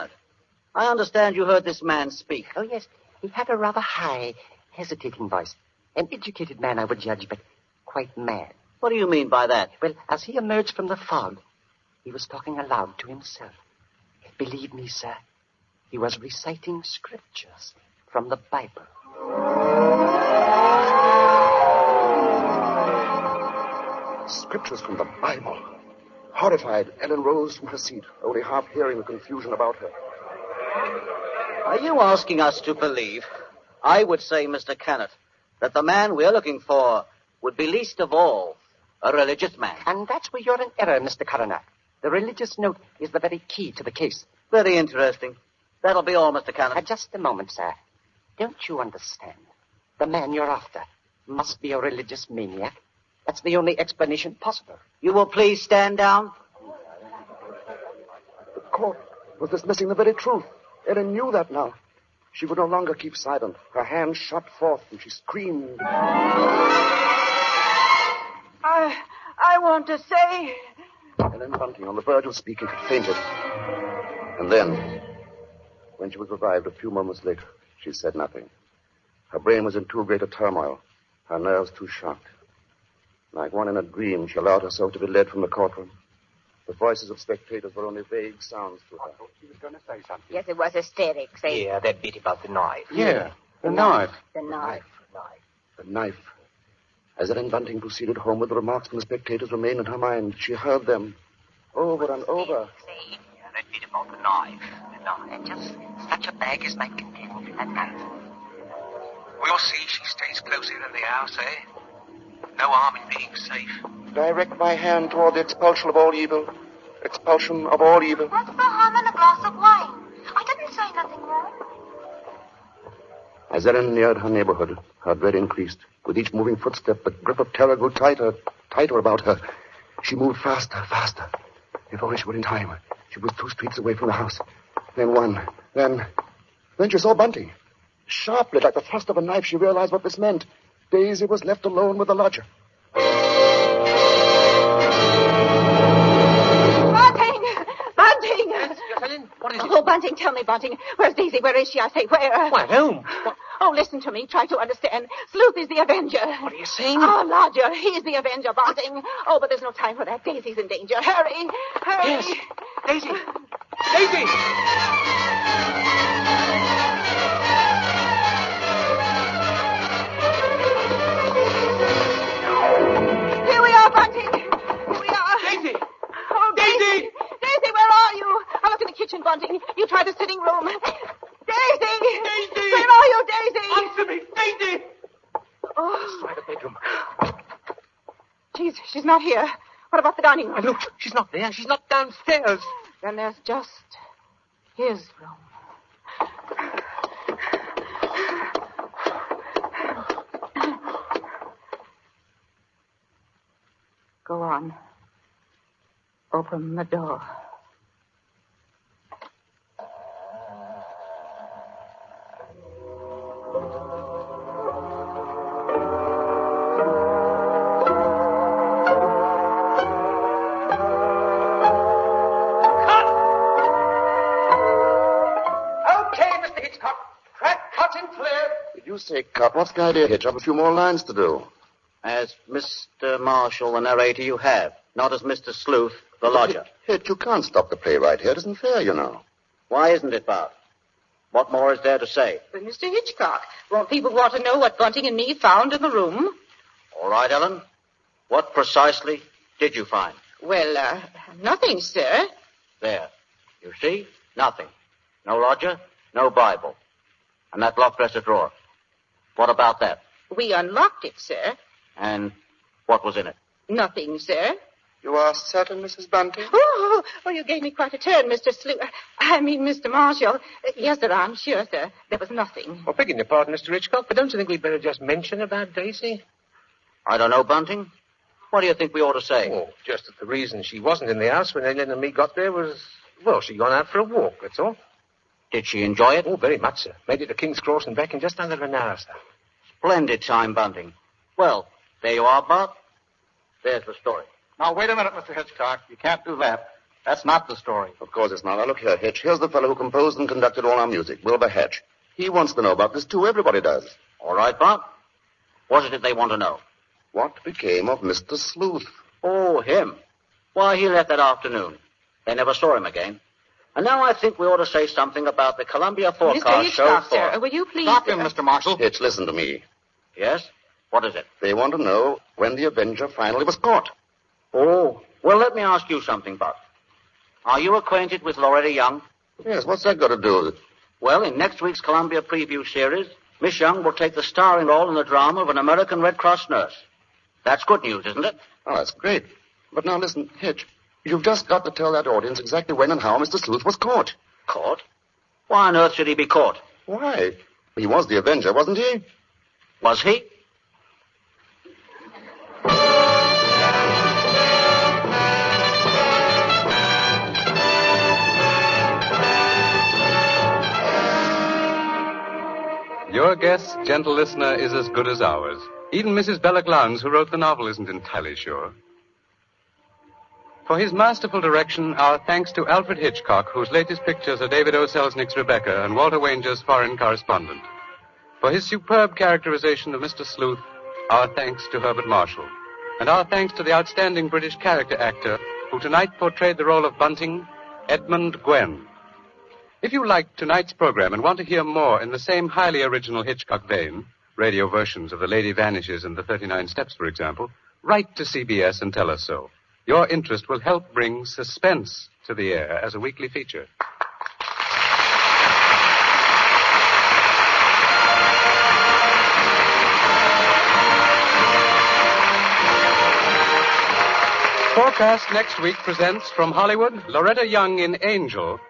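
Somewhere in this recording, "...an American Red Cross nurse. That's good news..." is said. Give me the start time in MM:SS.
05:35.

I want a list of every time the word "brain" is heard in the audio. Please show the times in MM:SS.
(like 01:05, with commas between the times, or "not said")
01:19.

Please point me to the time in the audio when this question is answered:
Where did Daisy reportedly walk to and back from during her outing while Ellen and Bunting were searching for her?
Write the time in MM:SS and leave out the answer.
04:47.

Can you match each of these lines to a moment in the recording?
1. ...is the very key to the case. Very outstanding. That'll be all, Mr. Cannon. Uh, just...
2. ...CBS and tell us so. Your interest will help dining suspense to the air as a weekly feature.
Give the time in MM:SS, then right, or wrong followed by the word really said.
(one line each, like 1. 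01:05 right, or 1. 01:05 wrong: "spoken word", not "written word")
1. 00:43 wrong: "interesting", not "outstanding"
2. 06:38 wrong: "bring", not "dining".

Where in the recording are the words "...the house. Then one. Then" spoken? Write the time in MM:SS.
02:14.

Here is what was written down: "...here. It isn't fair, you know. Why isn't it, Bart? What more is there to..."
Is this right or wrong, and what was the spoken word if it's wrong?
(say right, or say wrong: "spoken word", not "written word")
right.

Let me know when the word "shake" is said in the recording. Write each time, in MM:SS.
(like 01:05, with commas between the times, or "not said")
not said.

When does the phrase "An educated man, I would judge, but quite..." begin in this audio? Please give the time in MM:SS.
00:05.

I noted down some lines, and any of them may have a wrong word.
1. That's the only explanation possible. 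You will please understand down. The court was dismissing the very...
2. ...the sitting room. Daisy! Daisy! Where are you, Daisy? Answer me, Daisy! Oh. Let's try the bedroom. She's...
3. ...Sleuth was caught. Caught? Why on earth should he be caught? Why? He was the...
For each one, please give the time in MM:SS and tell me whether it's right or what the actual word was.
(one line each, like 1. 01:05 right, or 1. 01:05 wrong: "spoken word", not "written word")
1. 00:53 wrong: "stand", not "understand"
2. 03:00 right
3. 05:43 right.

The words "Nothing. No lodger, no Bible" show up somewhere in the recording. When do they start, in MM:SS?
04:14.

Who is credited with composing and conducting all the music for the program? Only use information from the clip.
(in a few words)
Wilbur Hatch.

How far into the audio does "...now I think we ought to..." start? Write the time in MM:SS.
05:13.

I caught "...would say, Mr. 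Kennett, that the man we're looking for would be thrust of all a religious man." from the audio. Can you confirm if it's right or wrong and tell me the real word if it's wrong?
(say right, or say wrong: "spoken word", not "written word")
wrong: "least", not "thrust".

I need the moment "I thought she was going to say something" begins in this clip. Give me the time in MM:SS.
01:29.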